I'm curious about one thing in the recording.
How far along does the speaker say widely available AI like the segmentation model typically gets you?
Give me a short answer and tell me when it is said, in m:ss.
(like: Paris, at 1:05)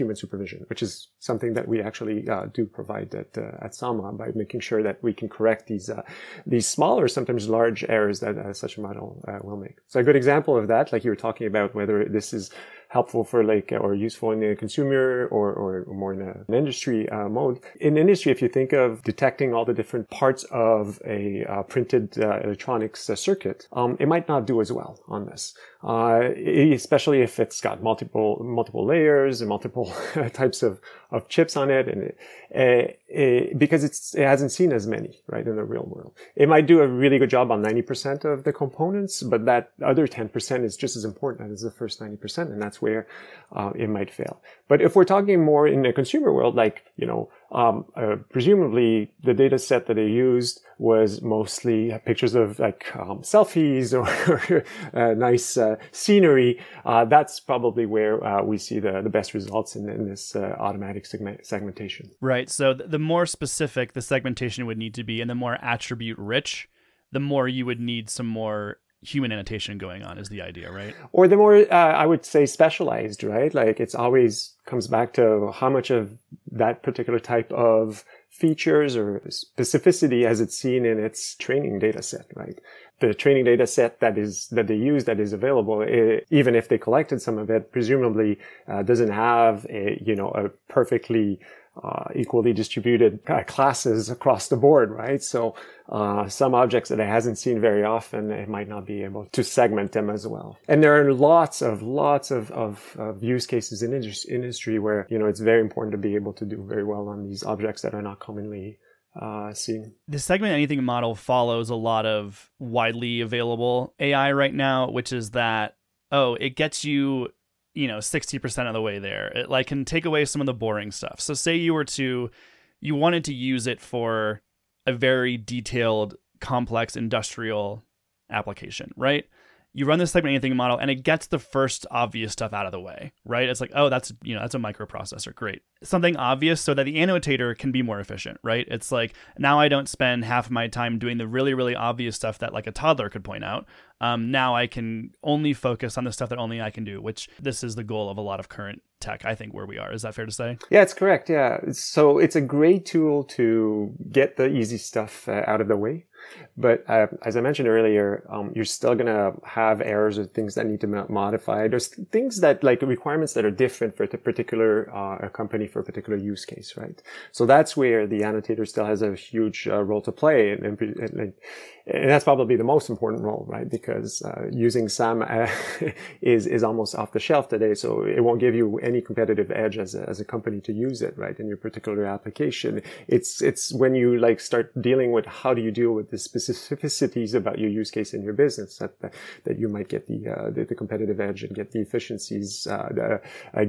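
60%, at 1:57.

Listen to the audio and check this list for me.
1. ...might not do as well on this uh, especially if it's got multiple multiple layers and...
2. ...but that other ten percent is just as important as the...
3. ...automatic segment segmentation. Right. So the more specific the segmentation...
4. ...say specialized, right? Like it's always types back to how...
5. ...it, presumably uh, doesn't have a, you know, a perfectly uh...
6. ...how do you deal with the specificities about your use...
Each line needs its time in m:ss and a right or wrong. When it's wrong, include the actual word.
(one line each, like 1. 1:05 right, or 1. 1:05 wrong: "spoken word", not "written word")
1. 0:24 right
2. 0:39 right
3. 1:00 right
4. 1:12 wrong: "comes", not "types"
5. 1:27 right
6. 3:05 right.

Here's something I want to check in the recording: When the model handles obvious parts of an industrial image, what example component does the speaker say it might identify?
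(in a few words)
a microprocessor.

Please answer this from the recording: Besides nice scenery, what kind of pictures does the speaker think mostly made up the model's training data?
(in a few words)
selfies.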